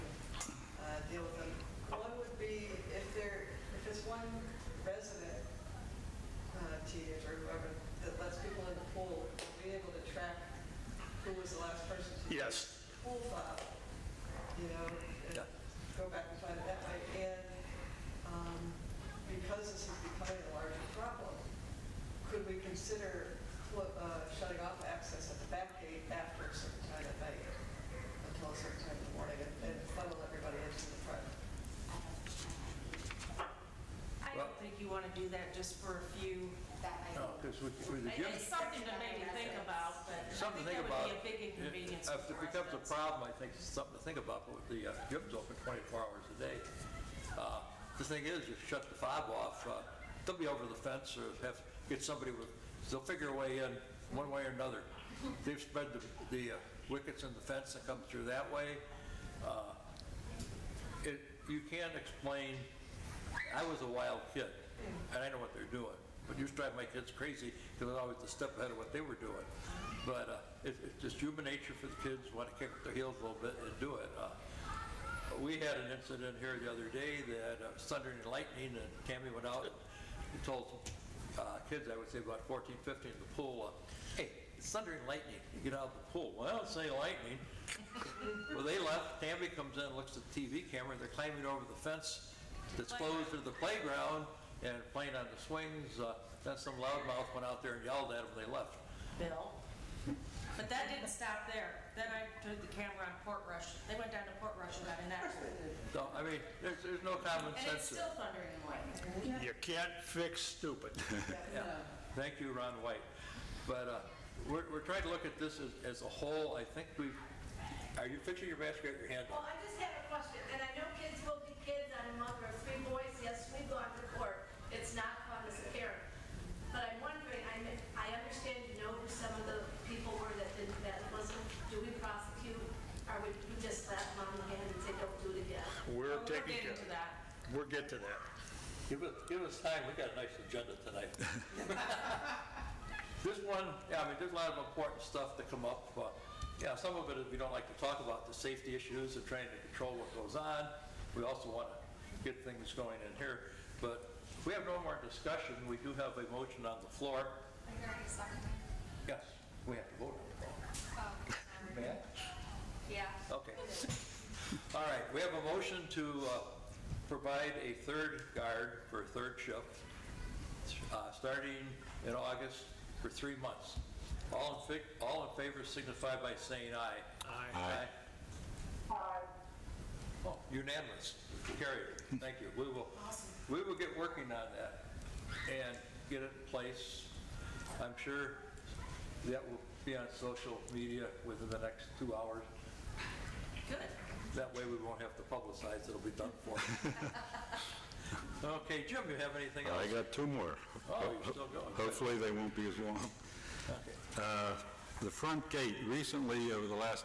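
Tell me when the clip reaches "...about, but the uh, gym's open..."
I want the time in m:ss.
0:44.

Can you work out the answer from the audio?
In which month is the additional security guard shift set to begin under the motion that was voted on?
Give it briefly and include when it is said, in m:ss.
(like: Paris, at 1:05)
August, at 2:52.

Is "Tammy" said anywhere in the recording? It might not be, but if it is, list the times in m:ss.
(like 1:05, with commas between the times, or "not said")
1:19, 1:29.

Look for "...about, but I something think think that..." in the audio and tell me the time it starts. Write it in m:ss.
0:39.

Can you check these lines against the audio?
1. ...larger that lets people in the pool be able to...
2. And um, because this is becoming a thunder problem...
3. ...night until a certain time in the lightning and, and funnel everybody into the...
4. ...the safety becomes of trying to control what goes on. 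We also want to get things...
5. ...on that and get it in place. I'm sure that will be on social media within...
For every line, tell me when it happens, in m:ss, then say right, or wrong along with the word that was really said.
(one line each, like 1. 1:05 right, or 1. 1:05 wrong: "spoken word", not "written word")
1. 0:07 wrong: "whoever", not "larger"
2. 0:17 wrong: "larger", not "thunder"
3. 0:27 wrong: "morning", not "lightning"
4. 2:28 wrong: "issues", not "becomes"
5. 3:04 right.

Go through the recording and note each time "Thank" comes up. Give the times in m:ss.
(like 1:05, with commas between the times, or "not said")
1:52, 3:01.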